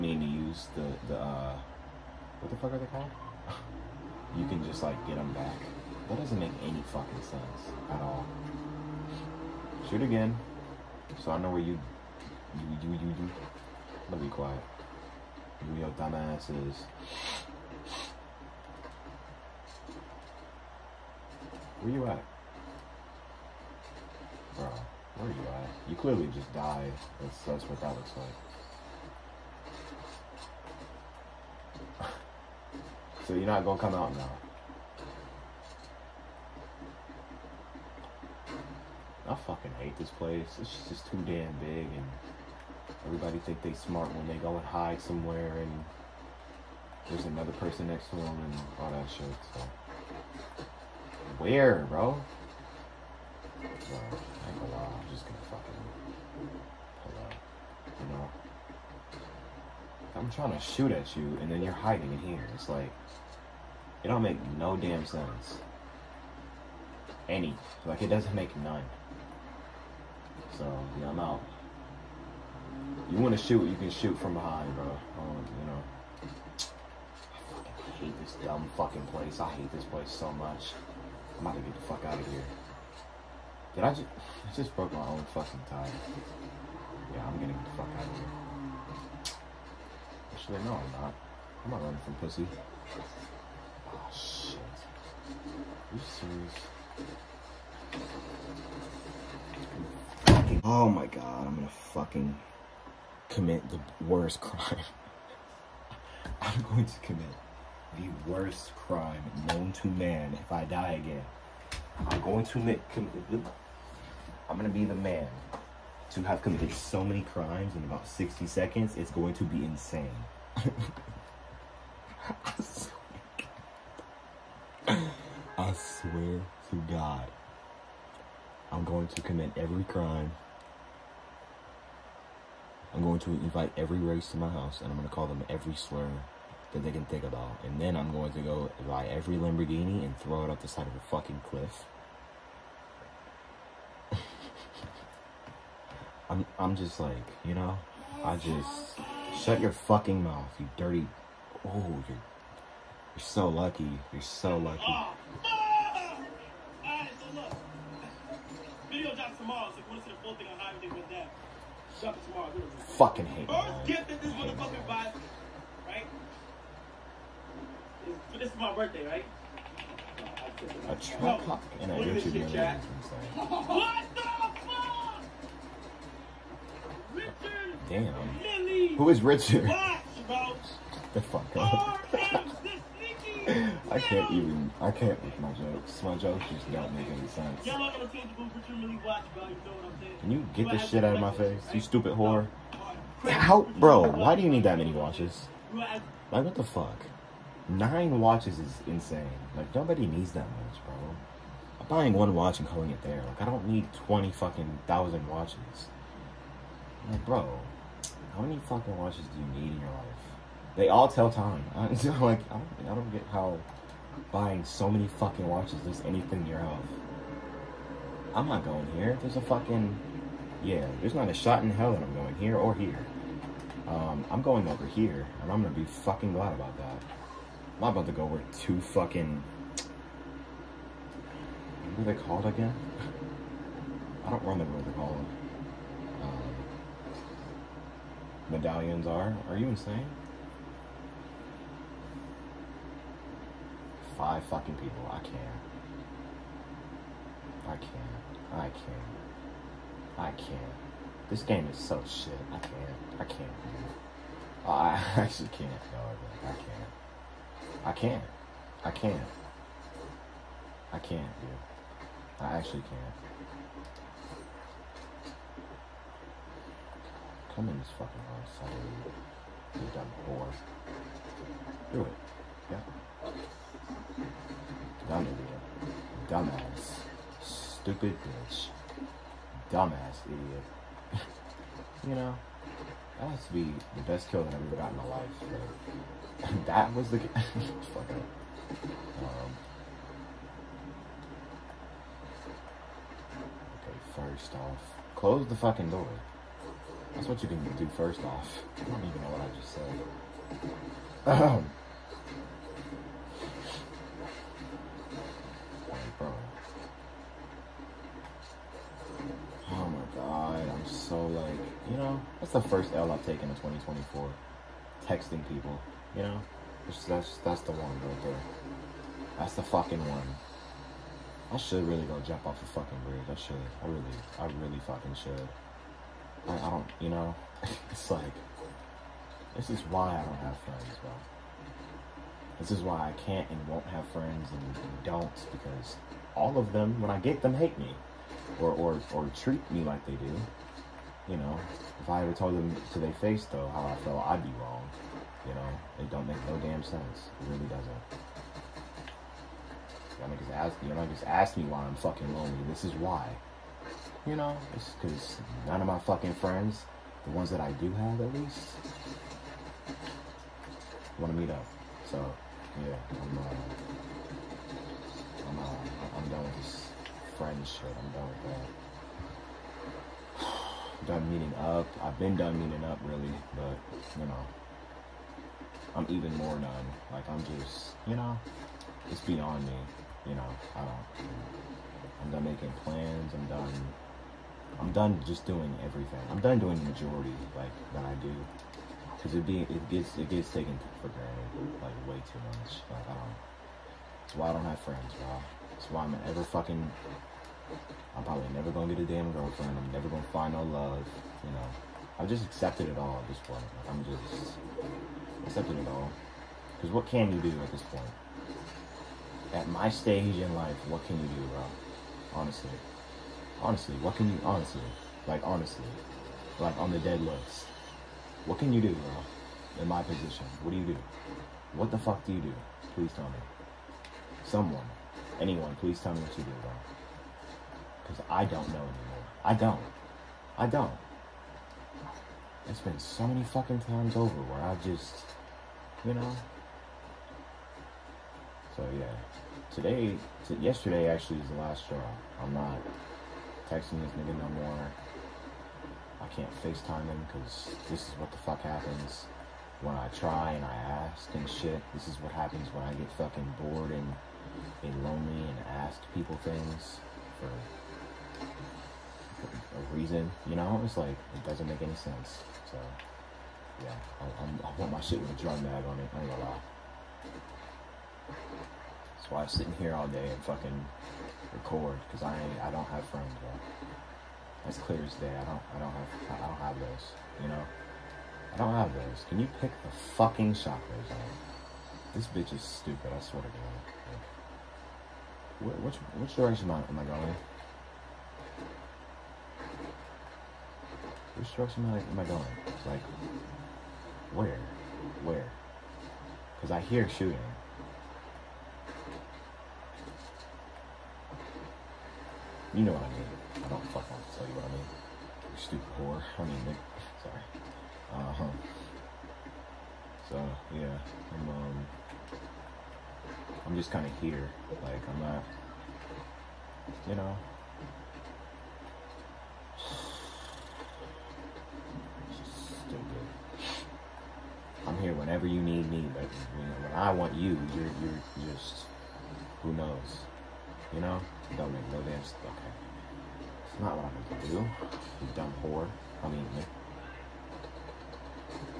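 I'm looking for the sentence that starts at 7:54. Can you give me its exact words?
That's clear as day, I don't, I don't have, I don't have those, you know?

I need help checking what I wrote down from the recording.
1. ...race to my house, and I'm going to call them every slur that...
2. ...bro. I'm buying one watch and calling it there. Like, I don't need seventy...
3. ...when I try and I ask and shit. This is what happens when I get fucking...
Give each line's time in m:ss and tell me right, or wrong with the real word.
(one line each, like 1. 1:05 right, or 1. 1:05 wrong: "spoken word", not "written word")
1. 2:13 right
2. 3:20 wrong: "twenty", not "seventy"
3. 7:29 right.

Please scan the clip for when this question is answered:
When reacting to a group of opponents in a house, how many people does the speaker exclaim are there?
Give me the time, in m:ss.
4:04.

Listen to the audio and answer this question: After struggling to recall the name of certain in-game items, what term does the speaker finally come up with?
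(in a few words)
Medallions.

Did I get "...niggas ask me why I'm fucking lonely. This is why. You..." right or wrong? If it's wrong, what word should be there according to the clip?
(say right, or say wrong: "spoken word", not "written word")
right.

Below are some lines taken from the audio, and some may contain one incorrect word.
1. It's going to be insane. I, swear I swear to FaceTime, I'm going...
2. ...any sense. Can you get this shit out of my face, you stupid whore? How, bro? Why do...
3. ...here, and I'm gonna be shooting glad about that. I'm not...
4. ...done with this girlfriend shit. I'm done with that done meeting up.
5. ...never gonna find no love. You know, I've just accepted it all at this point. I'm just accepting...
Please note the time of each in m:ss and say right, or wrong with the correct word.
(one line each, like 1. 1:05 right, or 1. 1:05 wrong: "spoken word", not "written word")
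1. 1:58 wrong: "God", not "FaceTime"
2. 3:07 right
3. 3:44 wrong: "fucking", not "shooting"
4. 6:06 wrong: "friend", not "girlfriend"
5. 6:39 right.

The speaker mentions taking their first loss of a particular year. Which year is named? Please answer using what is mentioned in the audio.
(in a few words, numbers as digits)
2024.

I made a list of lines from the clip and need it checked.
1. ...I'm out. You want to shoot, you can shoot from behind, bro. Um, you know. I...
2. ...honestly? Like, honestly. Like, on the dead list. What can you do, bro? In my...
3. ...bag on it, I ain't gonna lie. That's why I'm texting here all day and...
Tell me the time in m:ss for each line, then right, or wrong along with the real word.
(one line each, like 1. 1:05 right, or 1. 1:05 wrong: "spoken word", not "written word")
1. 1:11 right
2. 6:54 right
3. 7:45 wrong: "sitting", not "texting".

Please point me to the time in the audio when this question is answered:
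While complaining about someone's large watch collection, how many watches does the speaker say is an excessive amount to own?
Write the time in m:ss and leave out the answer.
3:17.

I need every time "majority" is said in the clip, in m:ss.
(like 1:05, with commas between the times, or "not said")
6:26.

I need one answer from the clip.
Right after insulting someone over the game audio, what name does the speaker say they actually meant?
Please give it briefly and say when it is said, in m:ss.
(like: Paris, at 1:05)
Nick, at 8:26.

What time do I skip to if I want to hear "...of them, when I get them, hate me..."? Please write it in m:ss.
5:36.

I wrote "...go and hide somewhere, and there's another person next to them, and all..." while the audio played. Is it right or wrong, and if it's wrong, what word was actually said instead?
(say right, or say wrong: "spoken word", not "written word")
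right.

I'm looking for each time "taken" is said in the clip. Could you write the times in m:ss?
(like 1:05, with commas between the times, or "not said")
5:13, 6:30.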